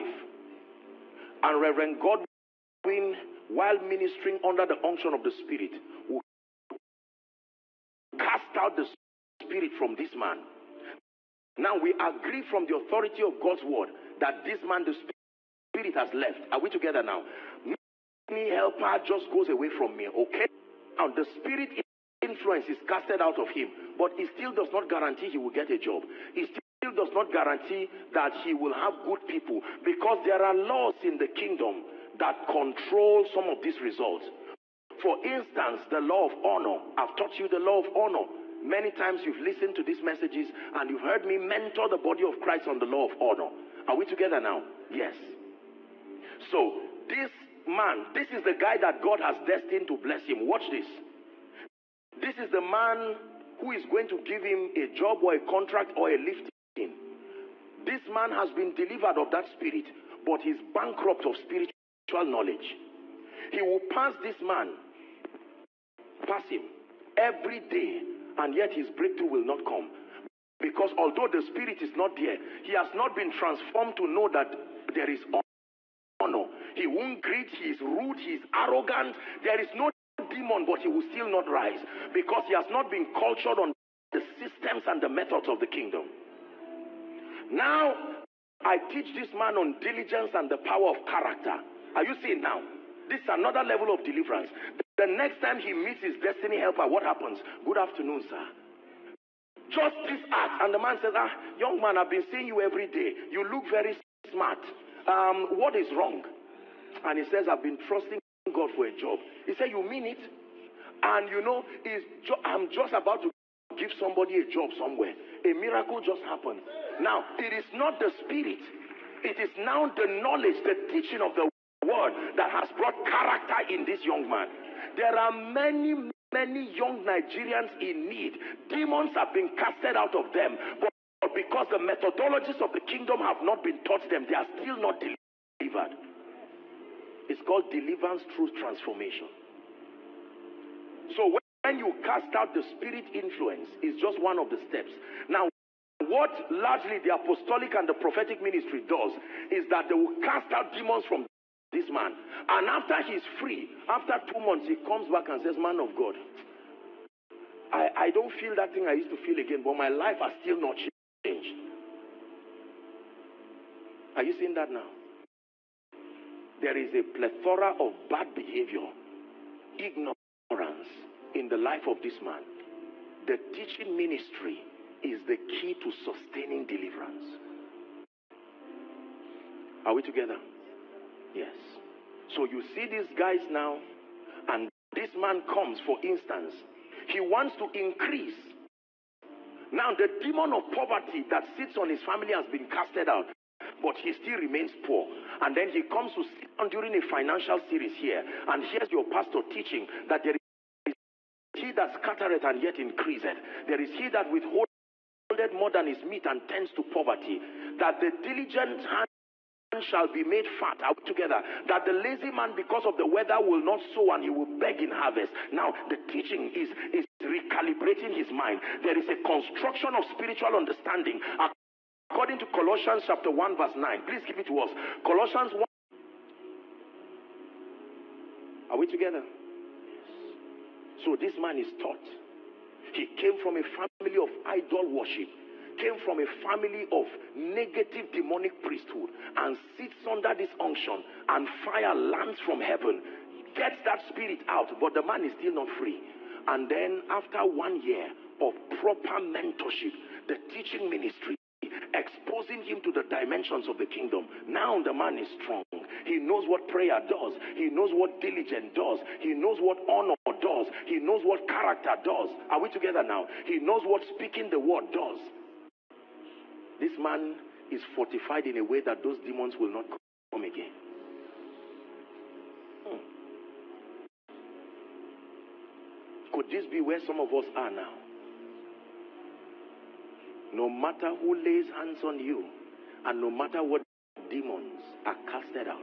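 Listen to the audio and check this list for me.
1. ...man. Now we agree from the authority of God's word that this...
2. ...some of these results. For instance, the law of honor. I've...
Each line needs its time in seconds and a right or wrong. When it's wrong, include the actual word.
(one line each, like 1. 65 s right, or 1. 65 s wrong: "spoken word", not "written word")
1. 10 s right
2. 33 s right.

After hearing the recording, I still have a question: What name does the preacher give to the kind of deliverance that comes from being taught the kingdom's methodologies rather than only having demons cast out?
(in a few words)
deliverance through transformation.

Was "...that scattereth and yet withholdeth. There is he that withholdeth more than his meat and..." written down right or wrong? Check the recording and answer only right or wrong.
wrong.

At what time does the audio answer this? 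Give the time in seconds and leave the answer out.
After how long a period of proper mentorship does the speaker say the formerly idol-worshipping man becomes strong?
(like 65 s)
247 s.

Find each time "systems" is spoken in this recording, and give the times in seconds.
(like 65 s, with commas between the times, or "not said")
84 s.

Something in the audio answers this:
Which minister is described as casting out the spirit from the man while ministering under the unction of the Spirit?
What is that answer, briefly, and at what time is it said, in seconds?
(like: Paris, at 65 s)
Reverend Godwin, at 1 s.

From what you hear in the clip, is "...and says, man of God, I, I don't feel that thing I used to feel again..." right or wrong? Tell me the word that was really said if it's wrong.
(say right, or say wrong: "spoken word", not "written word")
right.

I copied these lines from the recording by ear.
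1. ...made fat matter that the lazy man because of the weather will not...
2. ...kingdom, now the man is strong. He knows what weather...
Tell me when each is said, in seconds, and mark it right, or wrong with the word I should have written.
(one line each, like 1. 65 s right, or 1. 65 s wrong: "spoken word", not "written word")
1. 210 s wrong: "together", not "matter"
2. 253 s wrong: "prayer", not "weather".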